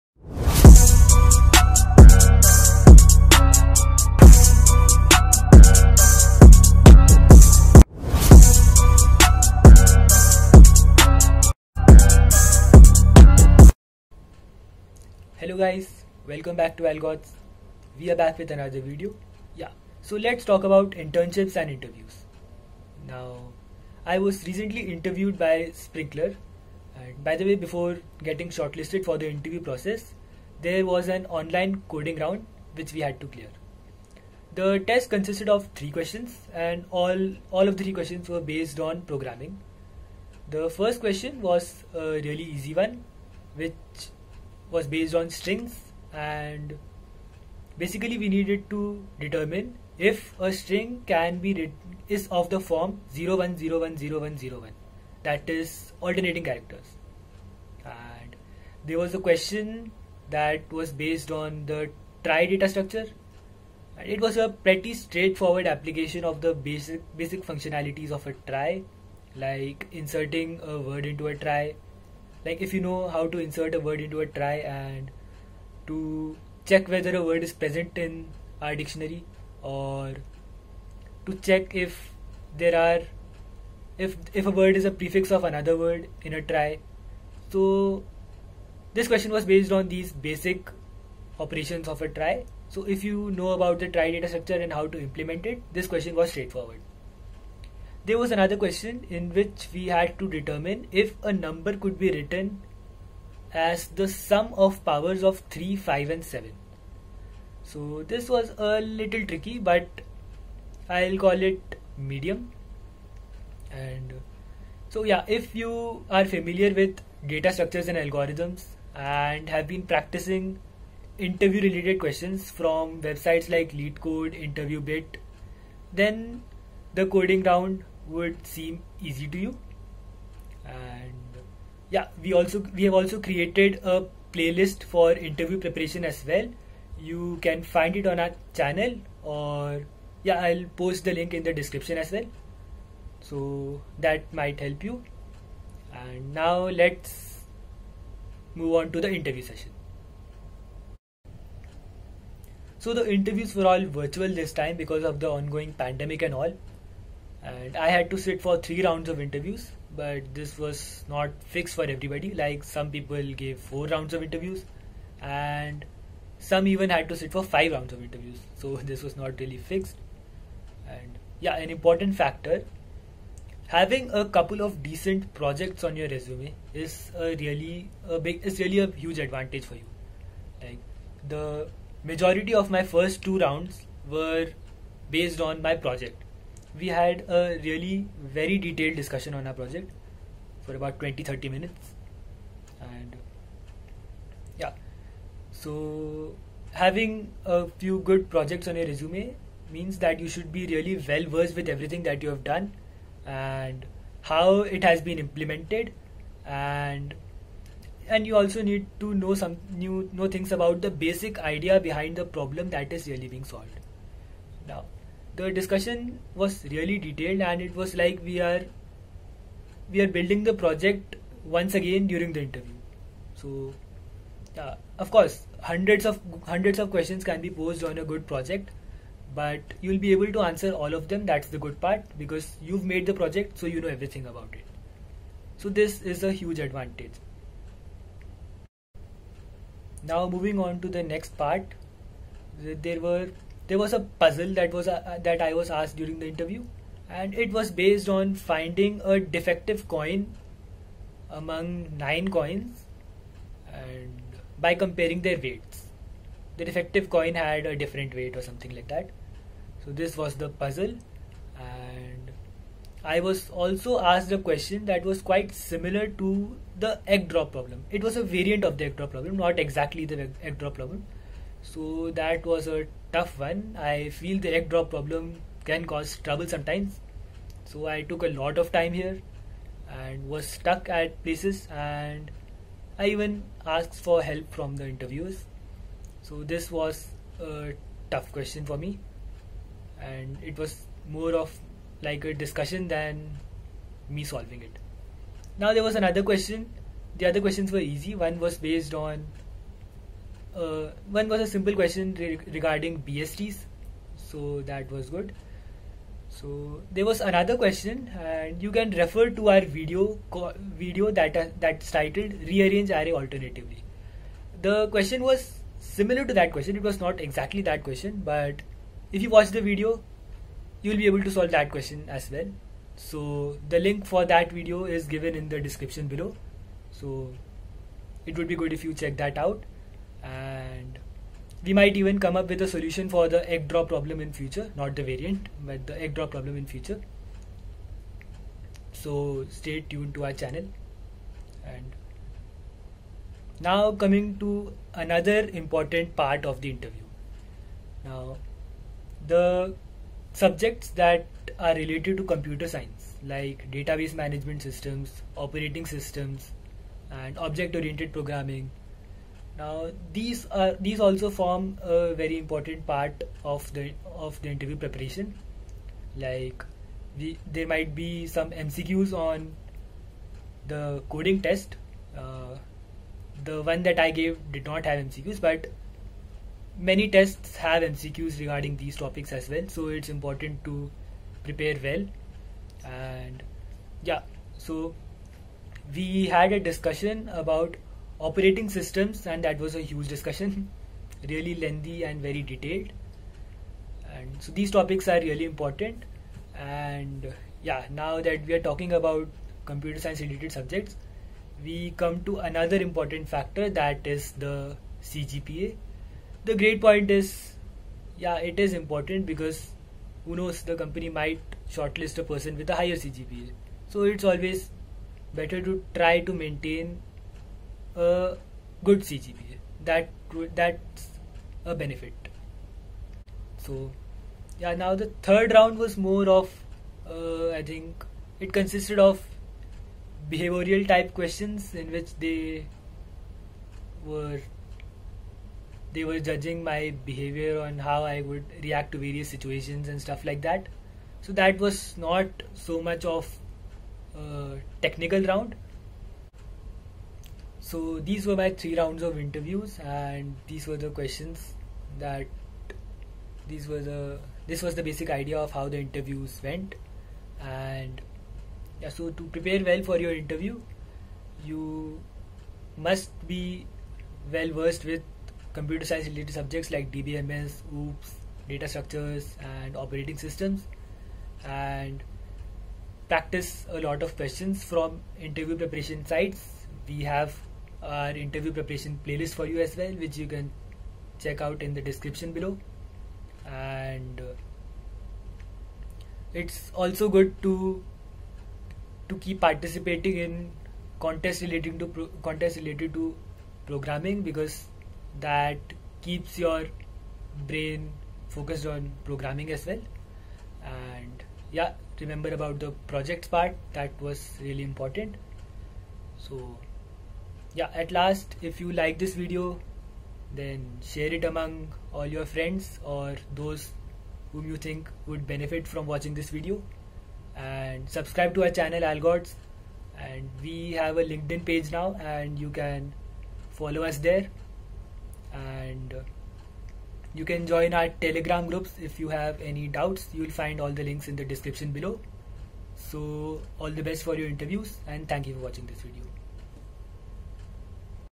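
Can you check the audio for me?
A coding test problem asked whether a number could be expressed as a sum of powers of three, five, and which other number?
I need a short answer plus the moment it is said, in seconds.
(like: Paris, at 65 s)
7, at 106 s.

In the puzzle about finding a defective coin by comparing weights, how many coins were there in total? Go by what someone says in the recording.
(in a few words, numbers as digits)
9.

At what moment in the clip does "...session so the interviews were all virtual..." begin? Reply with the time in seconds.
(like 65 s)
149 s.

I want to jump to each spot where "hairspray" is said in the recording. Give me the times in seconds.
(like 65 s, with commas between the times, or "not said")
not said.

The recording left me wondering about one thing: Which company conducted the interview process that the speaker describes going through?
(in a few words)
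Sprinklr.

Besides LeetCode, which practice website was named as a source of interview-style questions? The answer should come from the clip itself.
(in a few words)
InterviewBit.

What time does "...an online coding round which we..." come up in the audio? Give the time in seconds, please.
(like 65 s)
31 s.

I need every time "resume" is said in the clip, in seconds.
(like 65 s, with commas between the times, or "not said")
176 s, 198 s.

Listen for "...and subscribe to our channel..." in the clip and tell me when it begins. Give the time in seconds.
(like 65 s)
517 s.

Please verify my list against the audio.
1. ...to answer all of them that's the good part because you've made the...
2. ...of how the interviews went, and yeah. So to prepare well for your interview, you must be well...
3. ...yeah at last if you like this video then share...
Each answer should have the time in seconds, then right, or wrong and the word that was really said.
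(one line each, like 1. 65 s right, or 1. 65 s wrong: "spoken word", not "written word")
1. 230 s right
2. 455 s right
3. 507 s right.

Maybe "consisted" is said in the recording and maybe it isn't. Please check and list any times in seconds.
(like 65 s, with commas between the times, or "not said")
35 s, 428 s.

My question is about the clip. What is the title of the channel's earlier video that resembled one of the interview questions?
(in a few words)
Rearrange Array Alternatively.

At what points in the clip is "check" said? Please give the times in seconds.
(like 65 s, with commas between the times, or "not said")
76 s, 81 s, 328 s, 481 s.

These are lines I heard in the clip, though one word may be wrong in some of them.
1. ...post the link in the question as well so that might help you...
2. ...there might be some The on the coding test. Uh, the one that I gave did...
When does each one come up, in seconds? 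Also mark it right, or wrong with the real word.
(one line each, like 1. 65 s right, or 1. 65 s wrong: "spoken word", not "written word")
1. 140 s wrong: "description", not "question"
2. 367 s wrong: "MCQs", not "The".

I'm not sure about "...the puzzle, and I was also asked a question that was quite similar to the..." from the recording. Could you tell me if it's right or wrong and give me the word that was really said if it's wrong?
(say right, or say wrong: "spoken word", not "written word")
right.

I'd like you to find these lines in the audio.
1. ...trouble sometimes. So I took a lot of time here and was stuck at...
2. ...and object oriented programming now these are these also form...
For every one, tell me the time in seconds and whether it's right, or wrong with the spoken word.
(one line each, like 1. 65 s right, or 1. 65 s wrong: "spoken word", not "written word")
1. 276 s right
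2. 357 s right.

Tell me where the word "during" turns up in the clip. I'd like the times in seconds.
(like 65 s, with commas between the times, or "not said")
222 s, 245 s.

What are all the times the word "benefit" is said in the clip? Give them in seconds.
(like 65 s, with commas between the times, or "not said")
421 s, 515 s.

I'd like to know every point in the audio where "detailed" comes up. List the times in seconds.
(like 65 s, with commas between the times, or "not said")
188 s, 216 s, 392 s.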